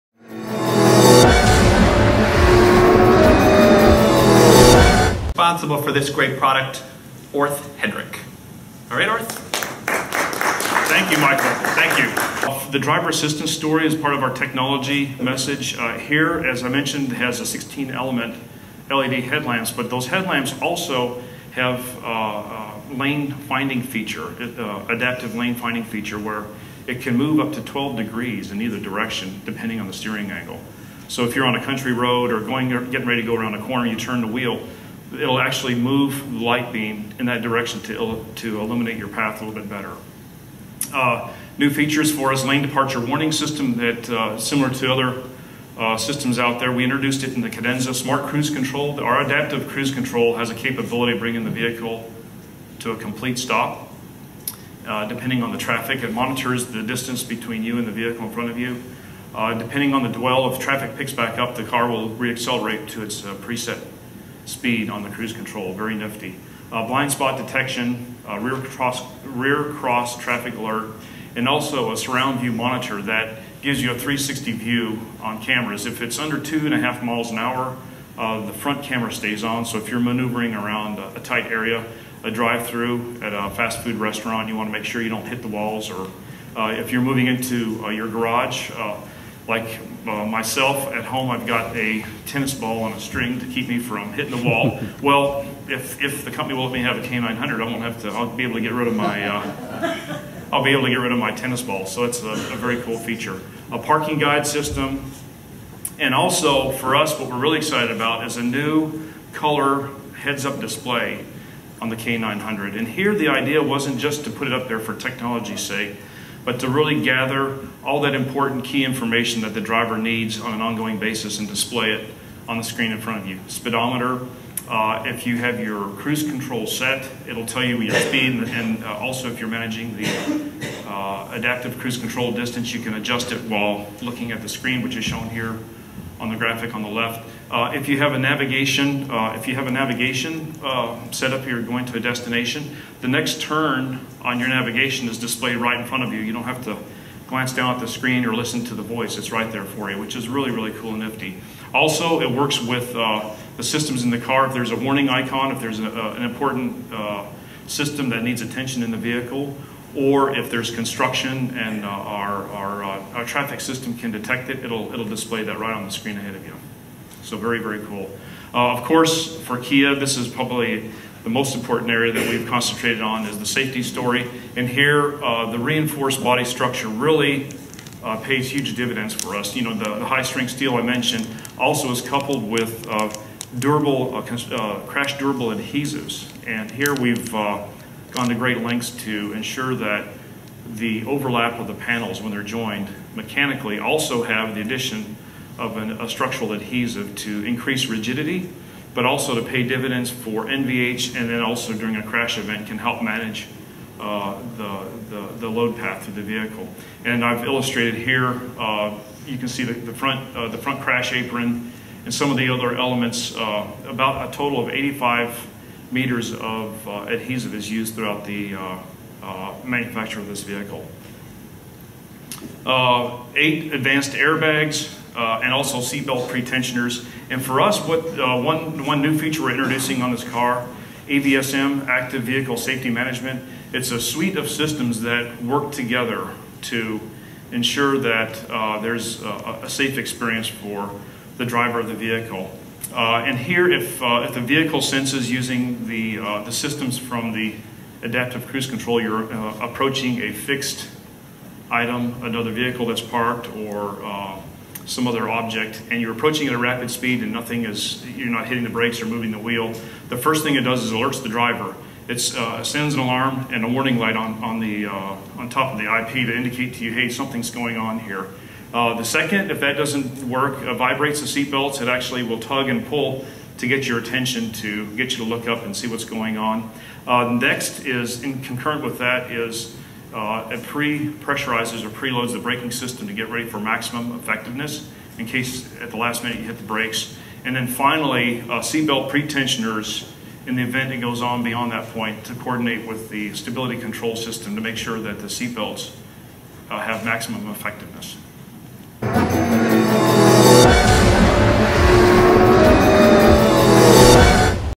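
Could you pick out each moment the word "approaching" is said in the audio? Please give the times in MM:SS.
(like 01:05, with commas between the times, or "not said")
04:09, 04:16.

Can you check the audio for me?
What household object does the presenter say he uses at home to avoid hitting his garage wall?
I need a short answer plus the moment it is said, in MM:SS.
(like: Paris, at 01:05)
tennis ball on a string, at 01:32.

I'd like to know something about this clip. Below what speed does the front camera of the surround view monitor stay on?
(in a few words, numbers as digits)
2.5 miles an hour.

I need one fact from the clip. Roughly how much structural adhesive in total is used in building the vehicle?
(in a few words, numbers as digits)
85 meters.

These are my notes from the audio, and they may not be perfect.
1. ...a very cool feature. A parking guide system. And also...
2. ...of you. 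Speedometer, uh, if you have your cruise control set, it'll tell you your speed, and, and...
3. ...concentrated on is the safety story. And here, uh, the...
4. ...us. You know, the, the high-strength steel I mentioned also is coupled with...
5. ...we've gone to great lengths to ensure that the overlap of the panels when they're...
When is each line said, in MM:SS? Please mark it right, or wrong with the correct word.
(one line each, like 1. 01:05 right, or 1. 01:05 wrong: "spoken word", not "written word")
1. 01:42 right
2. 02:03 right
3. 02:52 right
4. 02:59 right
5. 03:06 right.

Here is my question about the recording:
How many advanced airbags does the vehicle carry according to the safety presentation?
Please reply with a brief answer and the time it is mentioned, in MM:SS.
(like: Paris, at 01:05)
8, at 03:43.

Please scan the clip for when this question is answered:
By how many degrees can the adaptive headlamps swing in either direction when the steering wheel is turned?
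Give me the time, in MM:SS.
00:27.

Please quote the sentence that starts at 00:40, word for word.
Uh, new features for us, lane departure warning system that uh, similar to other uh, systems out there.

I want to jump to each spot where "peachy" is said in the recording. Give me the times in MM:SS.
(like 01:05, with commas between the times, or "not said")
not said.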